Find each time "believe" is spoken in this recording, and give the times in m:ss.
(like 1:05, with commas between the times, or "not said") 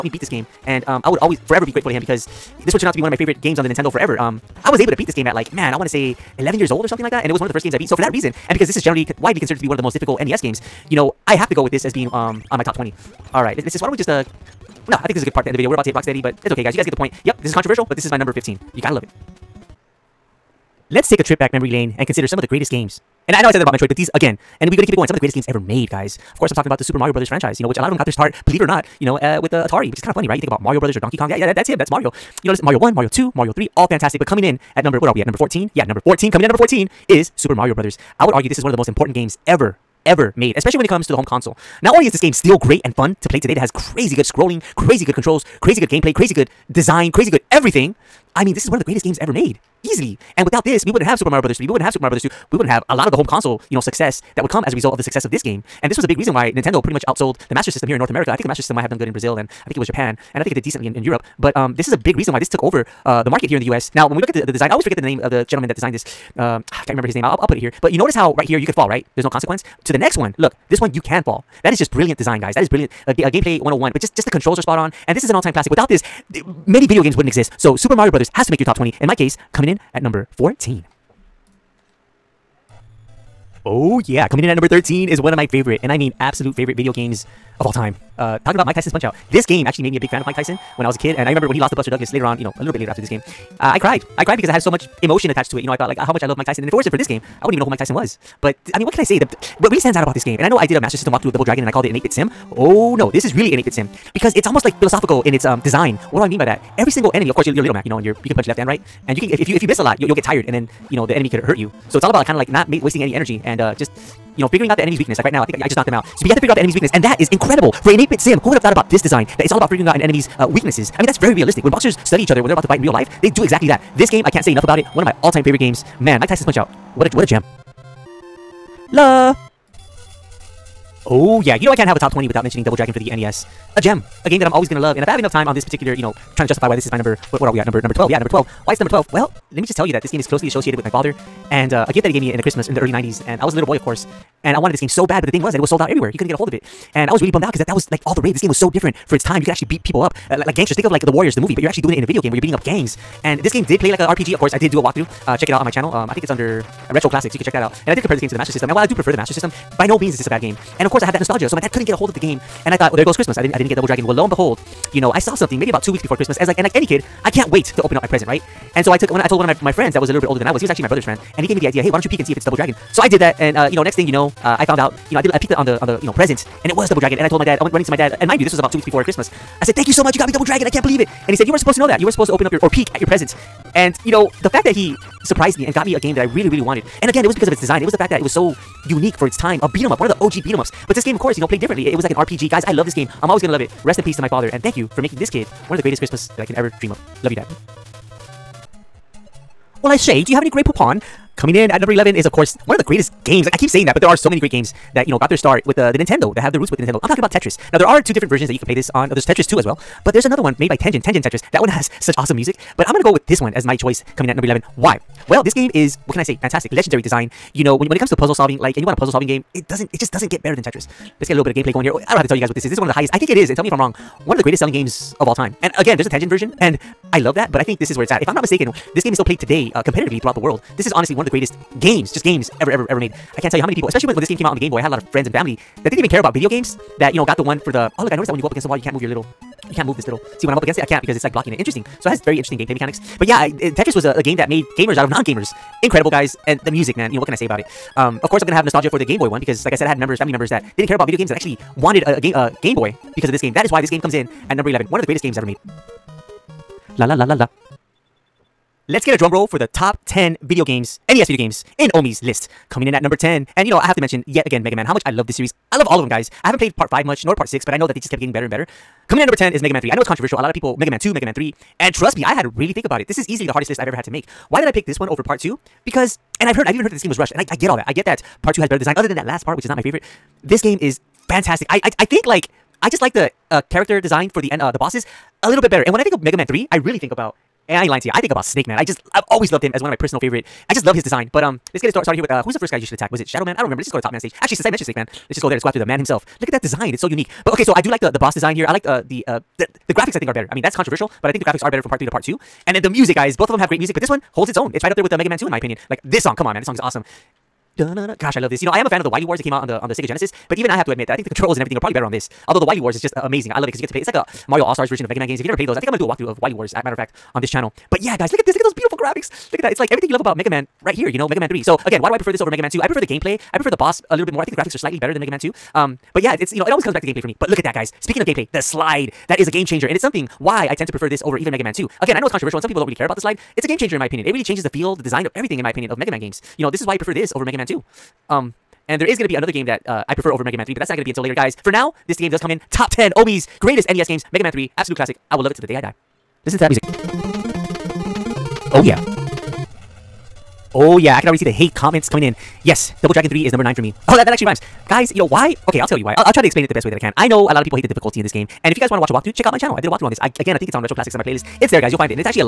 0:28, 3:00.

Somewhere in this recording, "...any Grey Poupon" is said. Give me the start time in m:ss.
3:20.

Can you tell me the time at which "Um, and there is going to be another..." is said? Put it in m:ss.
5:38.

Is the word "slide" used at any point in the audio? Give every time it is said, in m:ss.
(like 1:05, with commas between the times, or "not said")
5:28, 5:33.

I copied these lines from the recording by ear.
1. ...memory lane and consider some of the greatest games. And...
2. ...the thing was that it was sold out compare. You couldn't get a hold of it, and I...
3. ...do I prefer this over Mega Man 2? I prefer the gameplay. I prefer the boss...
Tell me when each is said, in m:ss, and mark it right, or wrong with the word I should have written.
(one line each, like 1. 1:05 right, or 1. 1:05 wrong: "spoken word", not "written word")
1. 0:21 right
2. 2:25 wrong: "everywhere", not "compare"
3. 5:22 right.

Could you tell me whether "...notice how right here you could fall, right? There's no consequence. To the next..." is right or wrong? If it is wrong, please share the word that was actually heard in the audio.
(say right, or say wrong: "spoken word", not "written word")
right.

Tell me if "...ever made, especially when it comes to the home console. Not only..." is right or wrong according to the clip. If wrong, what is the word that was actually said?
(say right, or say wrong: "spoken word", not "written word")
right.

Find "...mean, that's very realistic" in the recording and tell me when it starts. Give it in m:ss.
2:01.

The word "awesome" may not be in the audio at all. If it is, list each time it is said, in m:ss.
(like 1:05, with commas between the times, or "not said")
3:32, 5:06.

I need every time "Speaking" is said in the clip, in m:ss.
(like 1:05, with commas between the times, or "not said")
5:28.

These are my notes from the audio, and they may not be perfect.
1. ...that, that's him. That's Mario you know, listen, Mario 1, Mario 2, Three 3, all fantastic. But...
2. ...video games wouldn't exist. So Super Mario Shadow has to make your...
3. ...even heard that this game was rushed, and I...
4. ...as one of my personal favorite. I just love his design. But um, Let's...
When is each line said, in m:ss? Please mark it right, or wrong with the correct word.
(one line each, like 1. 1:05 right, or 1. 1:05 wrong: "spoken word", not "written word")
1. 0:31 wrong: "Mario", not "Three"
2. 1:16 wrong: "Brothers", not "Shadow"
3. 4:36 right
4. 4:49 right.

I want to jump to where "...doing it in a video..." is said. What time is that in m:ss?
2:31.